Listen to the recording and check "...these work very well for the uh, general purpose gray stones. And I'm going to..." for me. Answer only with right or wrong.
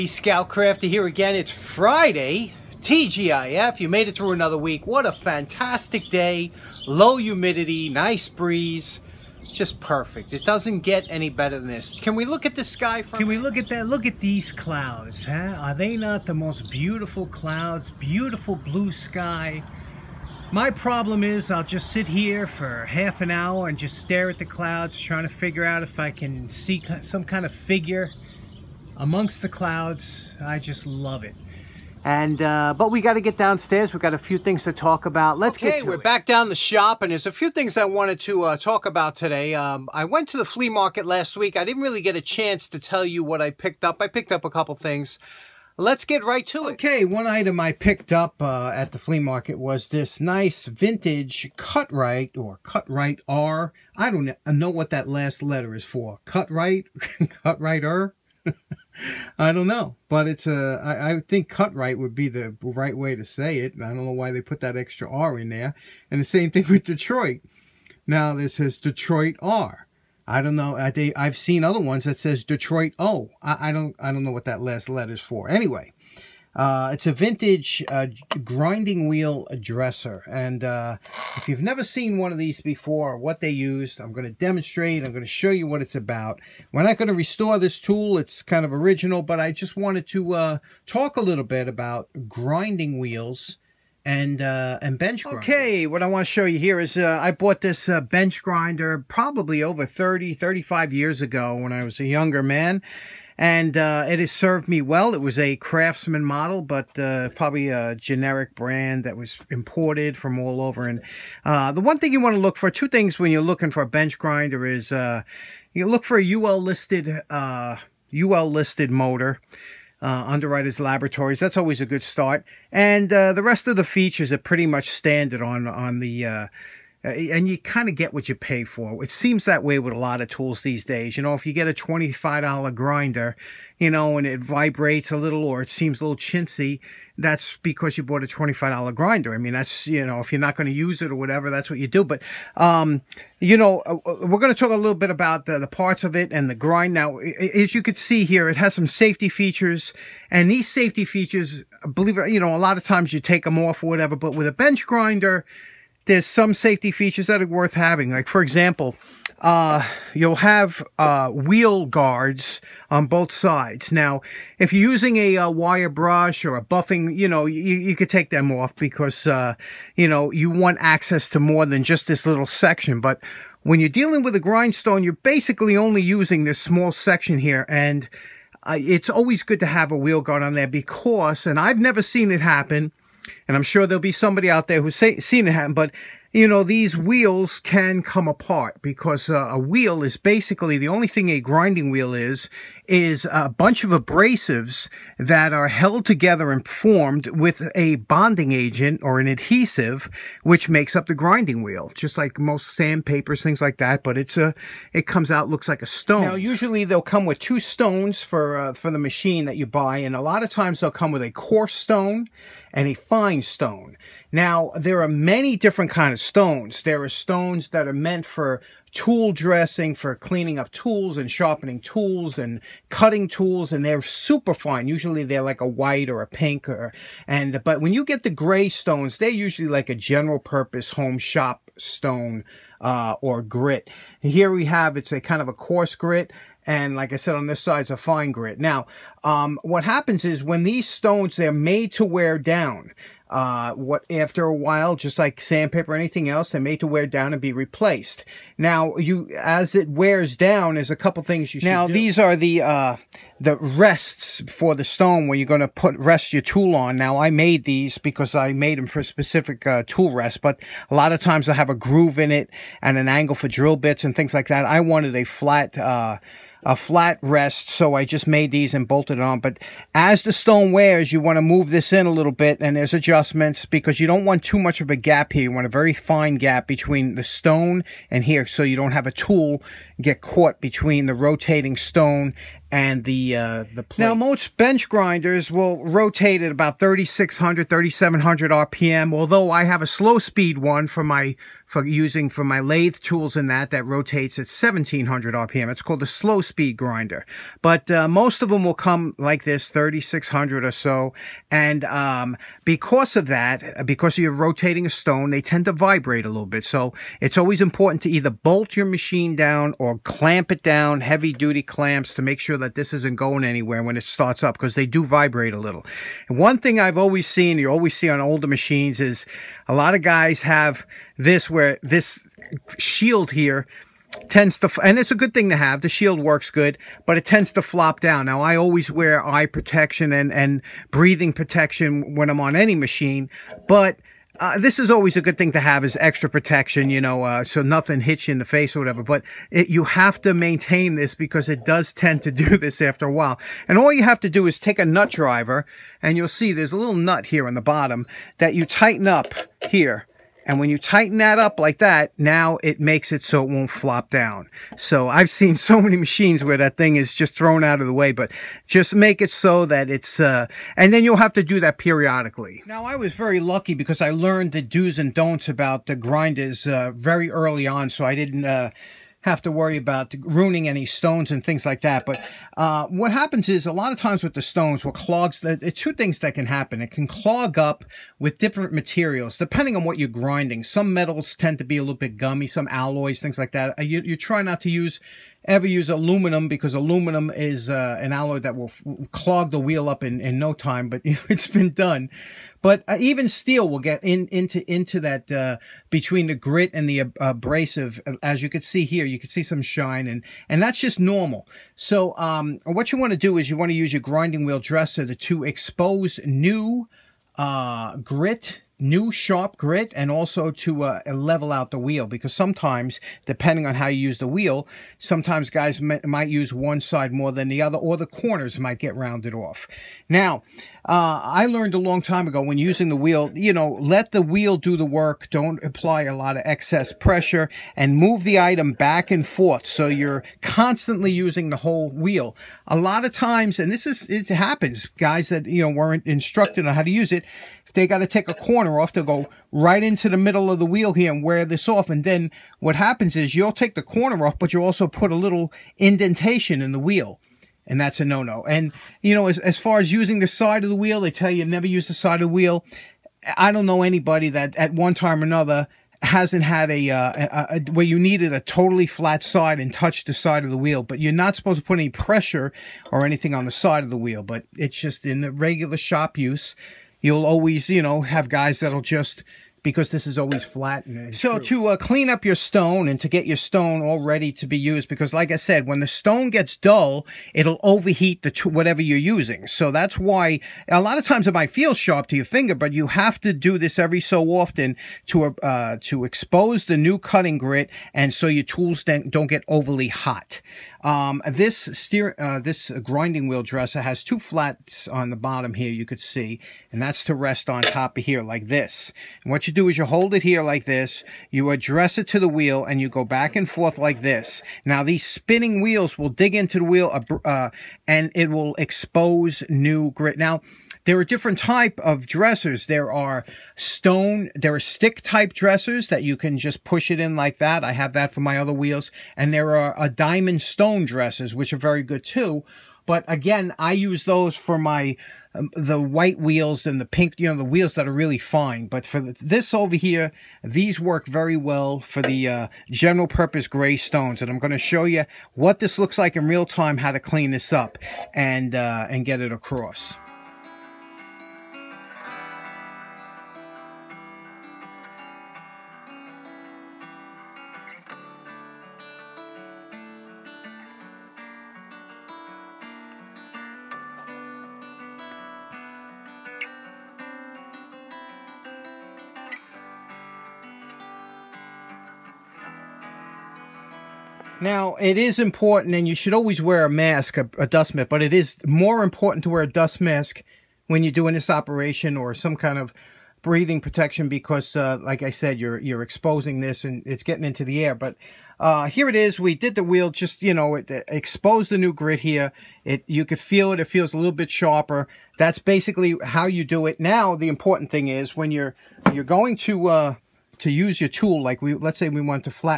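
right.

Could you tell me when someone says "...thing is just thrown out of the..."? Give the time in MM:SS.
05:56.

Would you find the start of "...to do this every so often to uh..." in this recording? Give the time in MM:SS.
08:03.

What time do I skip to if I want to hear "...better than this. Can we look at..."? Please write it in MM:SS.
00:11.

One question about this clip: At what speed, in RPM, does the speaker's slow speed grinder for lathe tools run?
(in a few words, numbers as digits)
1700 RPM.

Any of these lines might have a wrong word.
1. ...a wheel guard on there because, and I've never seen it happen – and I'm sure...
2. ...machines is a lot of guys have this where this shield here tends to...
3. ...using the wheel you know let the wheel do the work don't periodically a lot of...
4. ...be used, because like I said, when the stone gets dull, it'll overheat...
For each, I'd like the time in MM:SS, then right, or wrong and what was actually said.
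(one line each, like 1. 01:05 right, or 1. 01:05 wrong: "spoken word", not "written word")
1. 02:59 right
2. 05:18 right
3. 07:02 wrong: "apply", not "periodically"
4. 07:54 right.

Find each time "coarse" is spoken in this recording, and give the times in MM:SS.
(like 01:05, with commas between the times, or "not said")
03:31, 03:55.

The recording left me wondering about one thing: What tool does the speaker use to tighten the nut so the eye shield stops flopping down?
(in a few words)
Nut driver.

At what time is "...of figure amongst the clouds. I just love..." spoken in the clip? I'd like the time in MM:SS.
00:27.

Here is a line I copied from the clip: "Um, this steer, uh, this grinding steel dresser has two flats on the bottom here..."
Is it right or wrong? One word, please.
wrong.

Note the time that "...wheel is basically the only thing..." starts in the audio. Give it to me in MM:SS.
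03:09.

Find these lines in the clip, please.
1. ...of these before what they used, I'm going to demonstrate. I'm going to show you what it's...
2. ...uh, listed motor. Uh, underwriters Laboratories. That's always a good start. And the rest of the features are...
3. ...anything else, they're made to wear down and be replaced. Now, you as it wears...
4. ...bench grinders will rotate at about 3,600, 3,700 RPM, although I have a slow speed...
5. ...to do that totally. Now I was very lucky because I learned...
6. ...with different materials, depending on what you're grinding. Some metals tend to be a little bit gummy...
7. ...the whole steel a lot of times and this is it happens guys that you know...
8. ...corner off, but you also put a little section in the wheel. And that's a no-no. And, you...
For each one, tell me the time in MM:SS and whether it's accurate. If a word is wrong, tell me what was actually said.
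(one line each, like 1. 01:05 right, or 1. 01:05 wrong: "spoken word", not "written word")
1. 01:22 right
2. 01:57 right
3. 04:05 right
4. 04:44 right
5. 06:01 wrong: "periodically", not "totally"
6. 06:18 right
7. 07:11 wrong: "wheel", not "steel"
8. 07:23 wrong: "indentation", not "section".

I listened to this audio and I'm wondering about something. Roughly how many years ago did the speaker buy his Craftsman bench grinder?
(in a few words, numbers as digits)
30 to 35 years.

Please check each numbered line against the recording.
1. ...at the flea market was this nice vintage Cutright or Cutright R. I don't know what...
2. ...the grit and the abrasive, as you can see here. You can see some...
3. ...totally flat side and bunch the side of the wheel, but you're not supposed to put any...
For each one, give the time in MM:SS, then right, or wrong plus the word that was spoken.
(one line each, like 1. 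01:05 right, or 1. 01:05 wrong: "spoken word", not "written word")
1. 00:48 right
2. 06:36 right
3. 07:38 wrong: "touch", not "bunch".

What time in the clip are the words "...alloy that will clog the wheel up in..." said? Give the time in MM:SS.
06:28.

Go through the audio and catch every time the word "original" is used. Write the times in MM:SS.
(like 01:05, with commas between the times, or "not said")
01:28.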